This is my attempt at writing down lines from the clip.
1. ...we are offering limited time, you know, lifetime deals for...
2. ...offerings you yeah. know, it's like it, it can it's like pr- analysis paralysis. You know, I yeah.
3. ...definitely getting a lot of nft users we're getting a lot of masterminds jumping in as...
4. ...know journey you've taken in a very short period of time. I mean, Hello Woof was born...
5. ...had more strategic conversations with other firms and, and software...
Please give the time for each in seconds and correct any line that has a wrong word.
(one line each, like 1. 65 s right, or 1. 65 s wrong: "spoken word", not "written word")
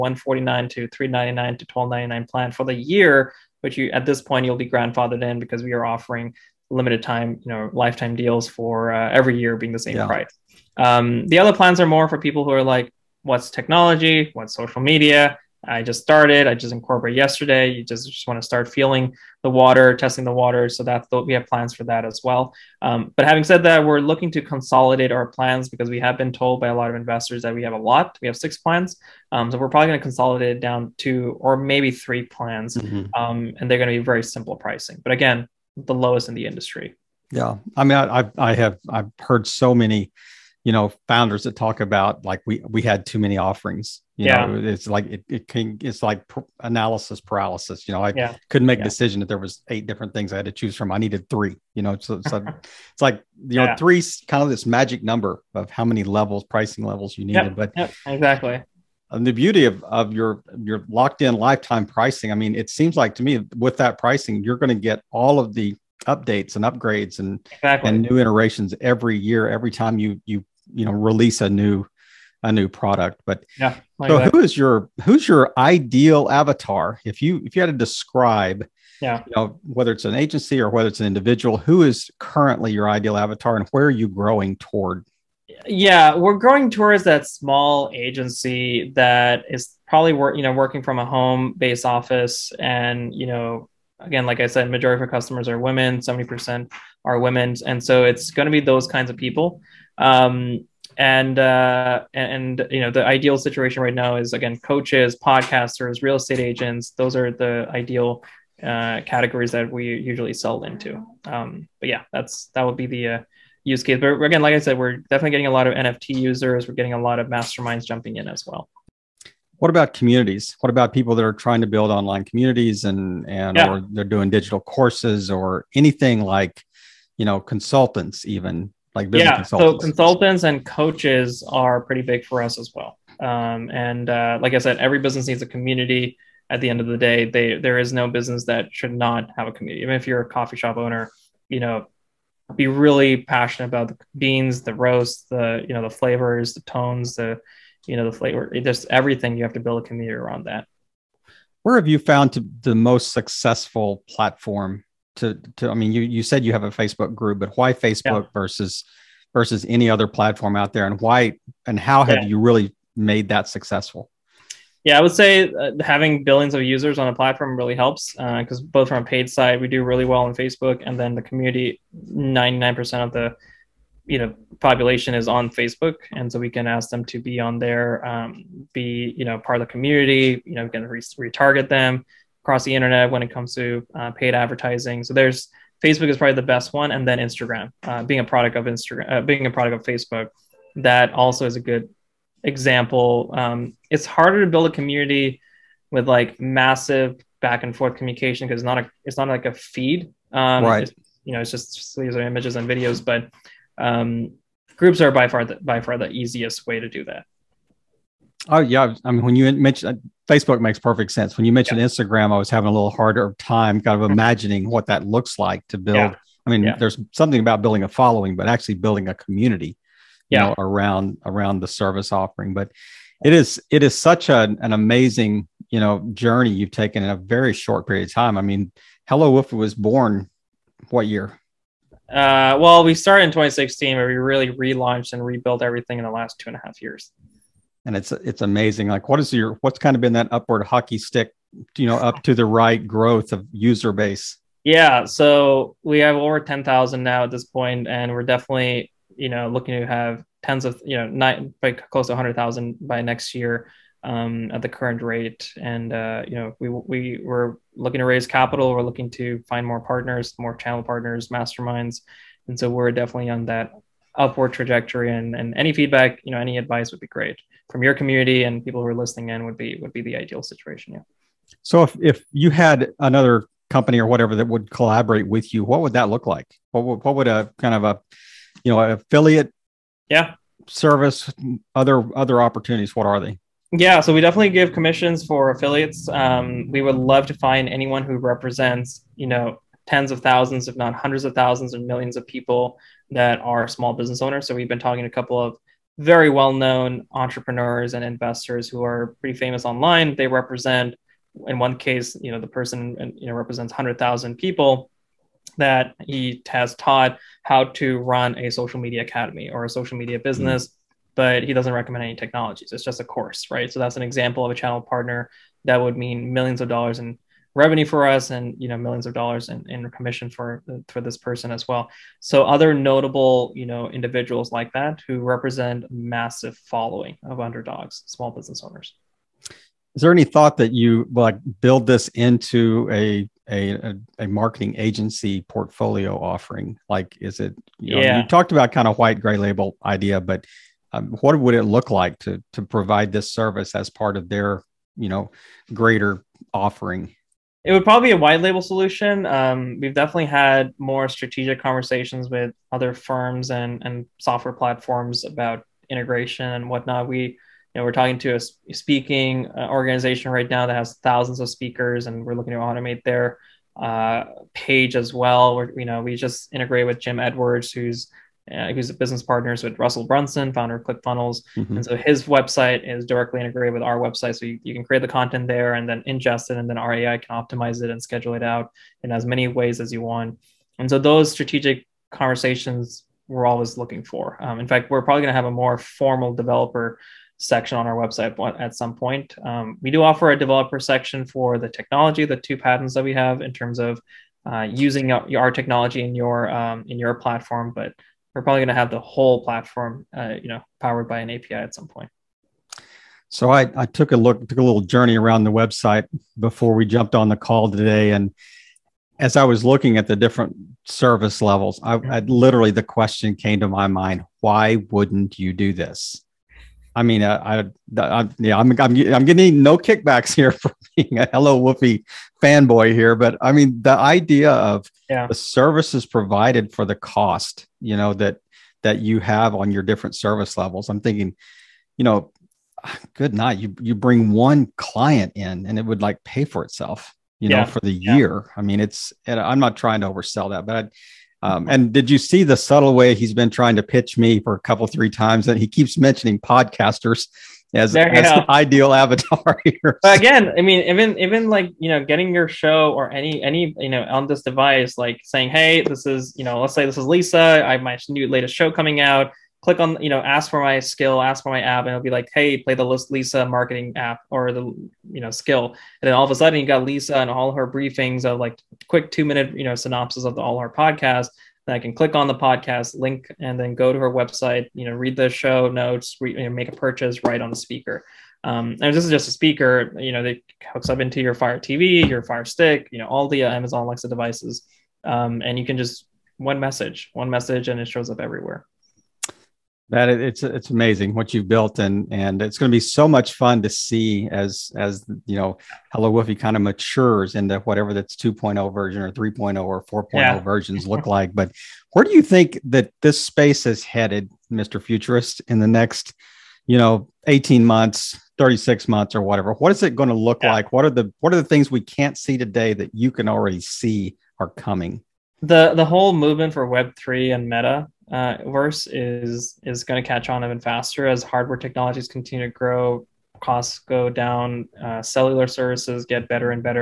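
1. 5 s right
2. 43 s right
3. 114 s right
4. 225 s right
5. 350 s right.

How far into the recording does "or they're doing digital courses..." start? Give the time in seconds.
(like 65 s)
123 s.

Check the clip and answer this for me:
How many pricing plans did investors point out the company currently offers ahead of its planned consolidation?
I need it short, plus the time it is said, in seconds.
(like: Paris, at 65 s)
6, at 28 s.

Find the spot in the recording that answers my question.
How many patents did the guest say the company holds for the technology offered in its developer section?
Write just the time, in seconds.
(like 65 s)
392 s.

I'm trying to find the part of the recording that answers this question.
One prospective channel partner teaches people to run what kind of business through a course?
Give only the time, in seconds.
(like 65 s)
309 s.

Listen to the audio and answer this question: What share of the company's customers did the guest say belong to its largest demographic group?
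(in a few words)
70%.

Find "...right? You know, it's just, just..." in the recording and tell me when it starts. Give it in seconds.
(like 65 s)
200 s.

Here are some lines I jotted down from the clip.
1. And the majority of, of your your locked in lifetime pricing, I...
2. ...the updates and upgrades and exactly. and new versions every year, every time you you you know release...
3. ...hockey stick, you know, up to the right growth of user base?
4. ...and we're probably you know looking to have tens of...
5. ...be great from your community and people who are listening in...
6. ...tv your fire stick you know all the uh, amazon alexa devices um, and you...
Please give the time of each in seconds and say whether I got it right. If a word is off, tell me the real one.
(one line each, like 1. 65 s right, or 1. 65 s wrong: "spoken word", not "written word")
1. 59 s wrong: "beauty", not "majority"
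2. 65 s wrong: "iterations", not "versions"
3. 240 s right
4. 247 s wrong: "definitely", not "probably"
5. 266 s right
6. 481 s right.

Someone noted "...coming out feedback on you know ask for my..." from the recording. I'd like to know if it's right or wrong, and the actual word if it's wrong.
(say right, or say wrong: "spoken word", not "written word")
wrong: "click", not "feedback".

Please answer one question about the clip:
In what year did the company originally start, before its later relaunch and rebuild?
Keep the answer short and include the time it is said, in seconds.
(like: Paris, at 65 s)
2016, at 233 s.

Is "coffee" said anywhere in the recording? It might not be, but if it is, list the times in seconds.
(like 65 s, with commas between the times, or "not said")
140 s.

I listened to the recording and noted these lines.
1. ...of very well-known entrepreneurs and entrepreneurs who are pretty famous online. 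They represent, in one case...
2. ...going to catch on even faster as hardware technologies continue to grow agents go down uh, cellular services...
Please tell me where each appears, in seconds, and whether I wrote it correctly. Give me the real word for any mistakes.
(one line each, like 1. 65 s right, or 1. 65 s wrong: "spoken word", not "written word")
1. 295 s wrong: "investors", not "entrepreneurs"
2. 519 s wrong: "costs", not "agents".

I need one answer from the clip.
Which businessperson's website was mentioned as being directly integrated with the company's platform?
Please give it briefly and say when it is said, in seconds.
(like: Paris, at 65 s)
Jim Edwards, at 366 s.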